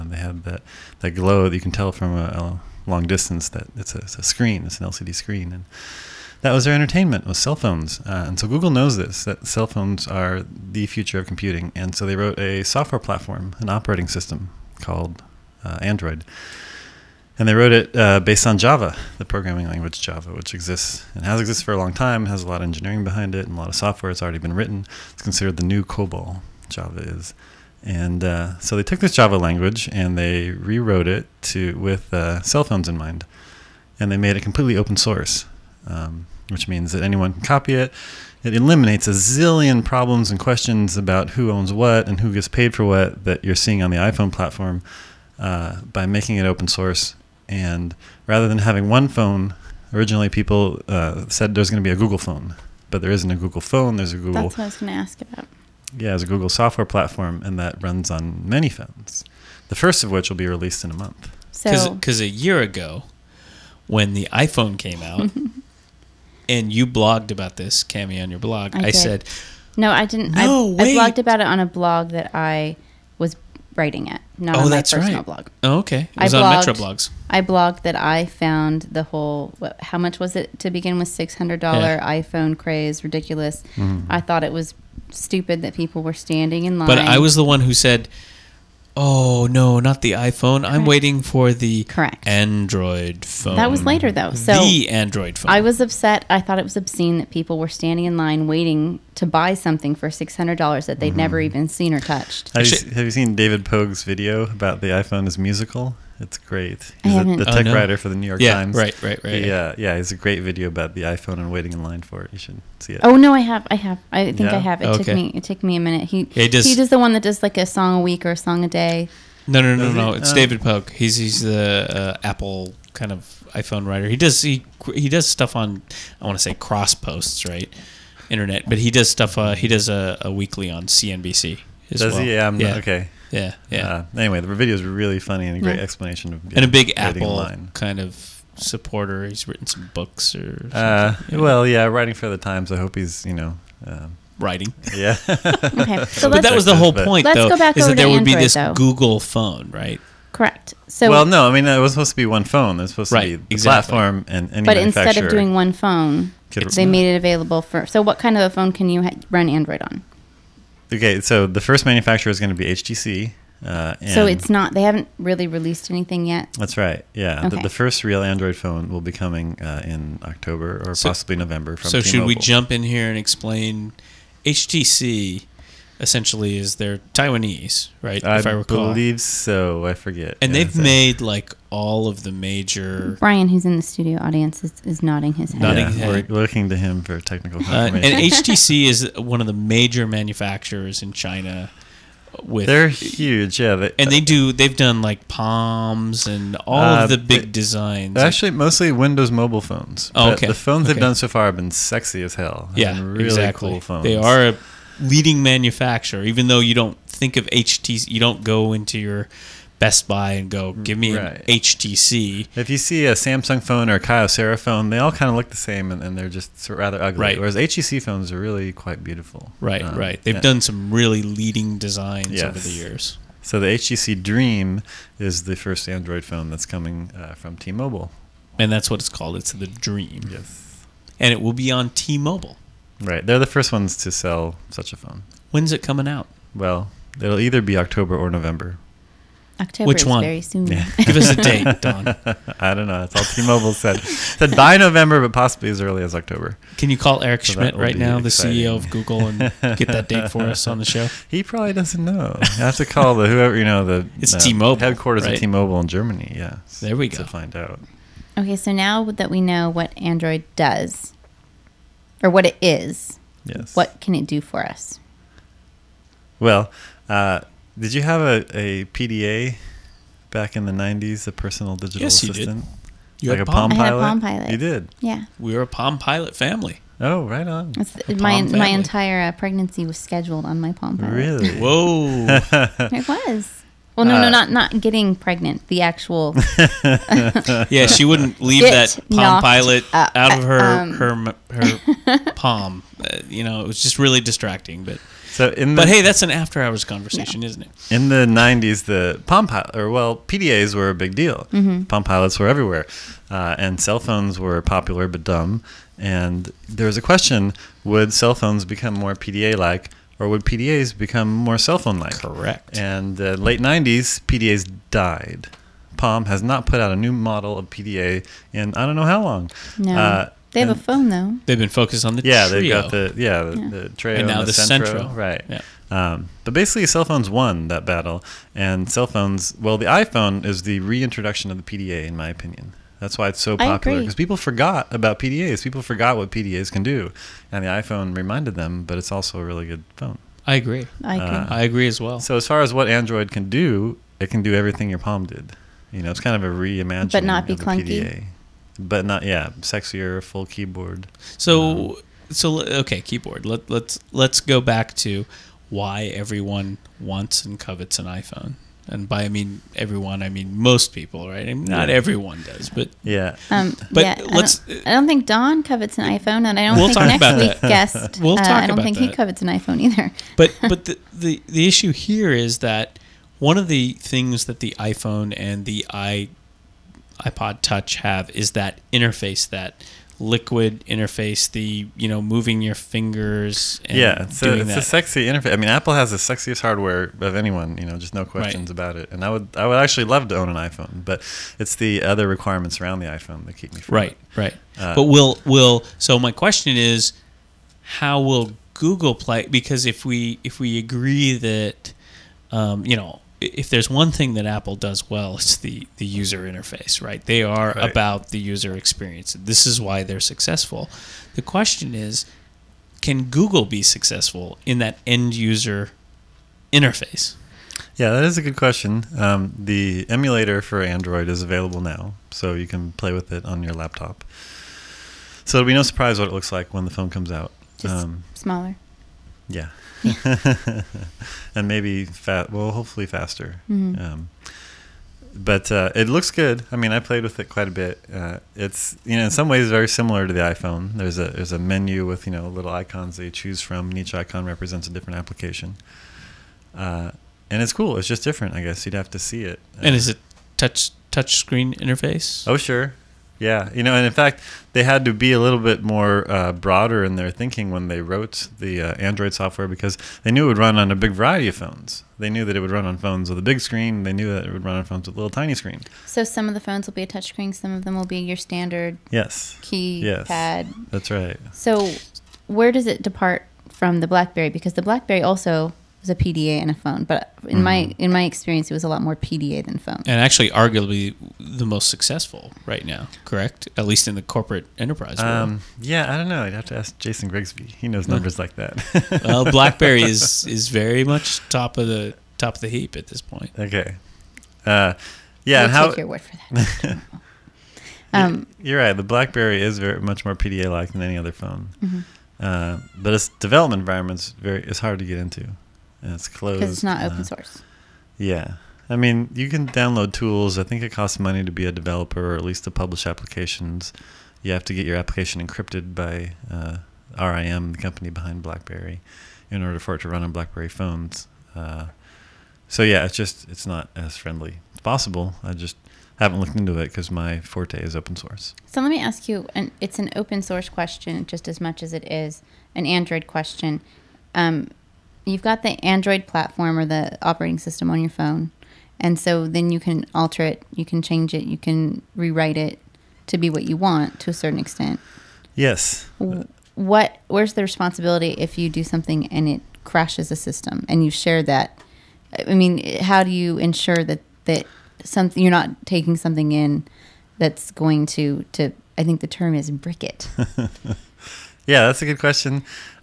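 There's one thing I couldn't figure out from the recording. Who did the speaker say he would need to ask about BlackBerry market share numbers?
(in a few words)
Jason Grigsby.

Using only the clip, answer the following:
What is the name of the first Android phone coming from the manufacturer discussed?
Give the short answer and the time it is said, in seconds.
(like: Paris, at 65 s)
HTC Dream, at 223 s.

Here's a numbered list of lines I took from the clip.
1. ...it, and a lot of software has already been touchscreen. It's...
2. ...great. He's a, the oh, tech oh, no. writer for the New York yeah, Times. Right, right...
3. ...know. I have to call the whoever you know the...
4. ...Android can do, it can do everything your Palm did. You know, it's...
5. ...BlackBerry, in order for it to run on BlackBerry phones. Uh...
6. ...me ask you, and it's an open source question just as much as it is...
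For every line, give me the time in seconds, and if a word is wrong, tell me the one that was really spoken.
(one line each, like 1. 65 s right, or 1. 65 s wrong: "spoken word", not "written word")
1. 23 s wrong: "written", not "touchscreen"
2. 106 s right
3. 252 s right
4. 342 s right
5. 518 s right
6. 528 s right.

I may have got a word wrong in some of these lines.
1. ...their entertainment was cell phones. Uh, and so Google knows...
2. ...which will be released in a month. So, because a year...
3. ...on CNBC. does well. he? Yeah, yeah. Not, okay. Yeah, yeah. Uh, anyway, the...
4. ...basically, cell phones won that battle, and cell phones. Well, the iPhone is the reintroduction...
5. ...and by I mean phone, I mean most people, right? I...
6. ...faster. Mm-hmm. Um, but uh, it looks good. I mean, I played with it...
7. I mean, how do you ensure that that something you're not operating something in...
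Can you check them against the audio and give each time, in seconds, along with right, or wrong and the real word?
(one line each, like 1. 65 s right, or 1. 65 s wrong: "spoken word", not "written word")
1. 6 s right
2. 60 s right
3. 130 s right
4. 326 s right
5. 358 s wrong: "everyone", not "phone"
6. 433 s right
7. 552 s wrong: "taking", not "operating".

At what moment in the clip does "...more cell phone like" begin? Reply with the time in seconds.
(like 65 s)
311 s.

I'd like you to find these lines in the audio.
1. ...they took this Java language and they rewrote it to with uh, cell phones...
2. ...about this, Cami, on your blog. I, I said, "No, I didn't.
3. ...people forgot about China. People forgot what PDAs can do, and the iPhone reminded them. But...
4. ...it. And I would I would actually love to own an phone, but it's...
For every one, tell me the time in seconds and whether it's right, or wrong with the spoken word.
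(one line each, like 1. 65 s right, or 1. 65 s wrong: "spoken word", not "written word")
1. 28 s right
2. 67 s right
3. 334 s wrong: "PDAs", not "China"
4. 388 s wrong: "iPhone", not "phone".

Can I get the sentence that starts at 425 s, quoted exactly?
So it'll be no surprise what it looks like when the phone comes out.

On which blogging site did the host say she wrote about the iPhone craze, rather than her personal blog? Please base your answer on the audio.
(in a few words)
Metro Blogs.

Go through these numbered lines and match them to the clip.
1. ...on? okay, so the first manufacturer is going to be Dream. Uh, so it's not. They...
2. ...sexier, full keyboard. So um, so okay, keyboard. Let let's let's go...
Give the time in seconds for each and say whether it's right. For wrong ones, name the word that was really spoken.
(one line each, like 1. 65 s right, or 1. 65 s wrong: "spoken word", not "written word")
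1. 159 s wrong: "HTC", not "Dream"
2. 349 s right.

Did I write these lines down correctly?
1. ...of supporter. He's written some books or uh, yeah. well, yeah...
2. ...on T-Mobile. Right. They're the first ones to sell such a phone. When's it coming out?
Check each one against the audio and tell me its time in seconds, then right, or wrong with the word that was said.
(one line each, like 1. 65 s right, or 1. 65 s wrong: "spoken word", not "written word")
1. 137 s right
2. 231 s right.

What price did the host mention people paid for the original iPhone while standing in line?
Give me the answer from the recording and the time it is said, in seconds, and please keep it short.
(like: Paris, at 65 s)
$600, at 81 s.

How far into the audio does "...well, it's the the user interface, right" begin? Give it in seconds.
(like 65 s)
405 s.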